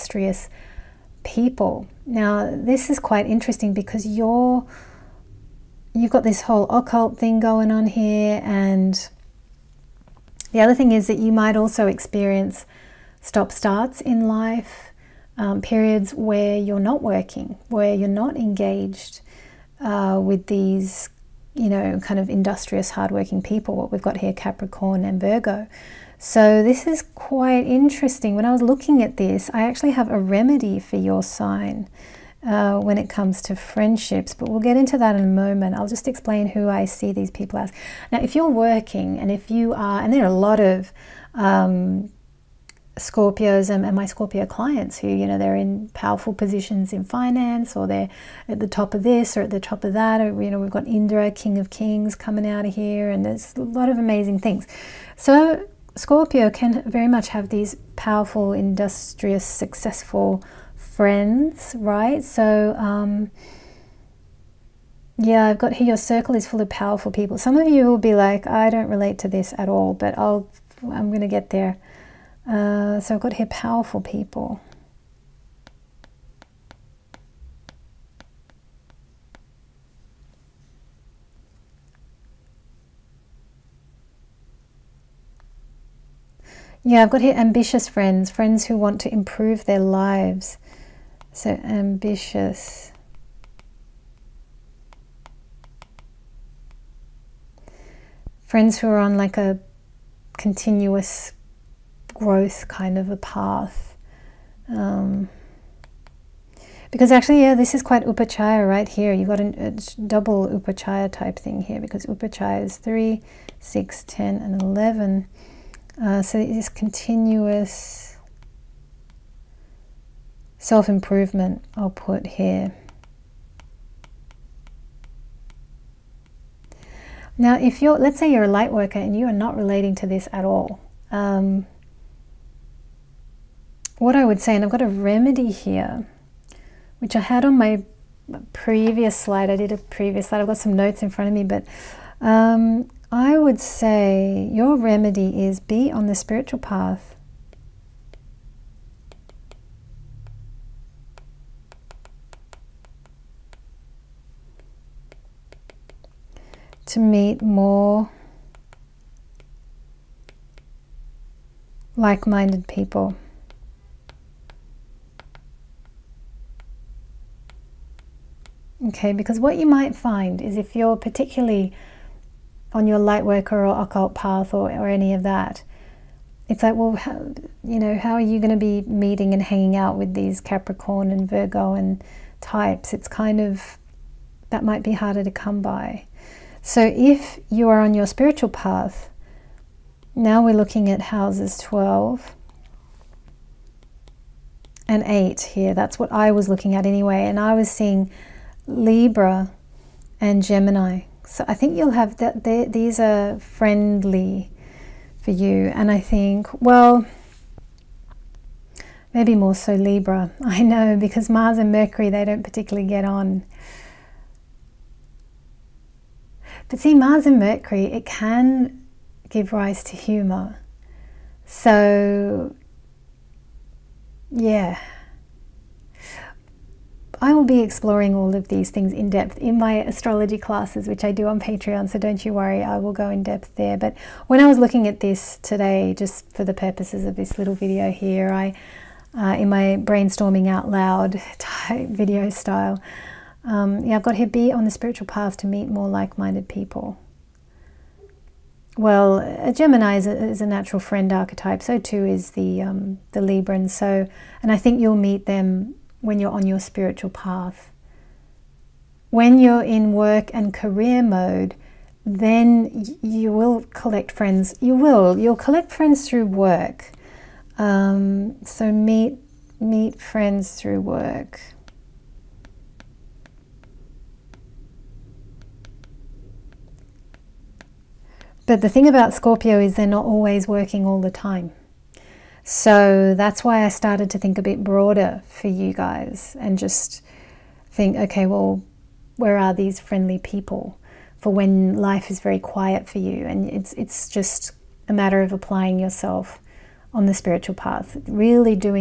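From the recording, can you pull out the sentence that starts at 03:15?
That's what I was looking at anyway.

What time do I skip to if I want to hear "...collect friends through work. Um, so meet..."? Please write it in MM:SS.
04:25.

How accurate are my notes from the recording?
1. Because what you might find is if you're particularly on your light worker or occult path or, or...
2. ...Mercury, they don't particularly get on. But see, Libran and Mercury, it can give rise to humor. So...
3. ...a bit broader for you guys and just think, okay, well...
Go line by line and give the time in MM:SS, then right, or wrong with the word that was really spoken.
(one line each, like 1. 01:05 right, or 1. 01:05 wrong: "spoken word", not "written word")
1. 02:49 right
2. 03:31 wrong: "Mars", not "Libran"
3. 04:44 right.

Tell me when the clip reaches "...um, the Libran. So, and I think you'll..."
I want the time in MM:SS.
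04:12.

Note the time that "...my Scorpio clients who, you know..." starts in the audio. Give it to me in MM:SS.
00:43.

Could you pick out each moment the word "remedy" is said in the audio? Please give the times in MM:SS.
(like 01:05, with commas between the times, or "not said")
00:30, 02:14, 02:24.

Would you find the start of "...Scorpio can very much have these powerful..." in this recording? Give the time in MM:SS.
00:55.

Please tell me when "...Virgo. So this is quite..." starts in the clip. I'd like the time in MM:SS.
00:25.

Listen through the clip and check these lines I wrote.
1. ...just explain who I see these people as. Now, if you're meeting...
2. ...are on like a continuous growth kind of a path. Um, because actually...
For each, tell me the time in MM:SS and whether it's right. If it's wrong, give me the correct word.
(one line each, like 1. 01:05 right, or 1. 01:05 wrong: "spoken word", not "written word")
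1. 00:35 wrong: "working", not "meeting"
2. 01:38 right.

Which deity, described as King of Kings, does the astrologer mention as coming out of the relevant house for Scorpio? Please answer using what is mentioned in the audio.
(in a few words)
Indra.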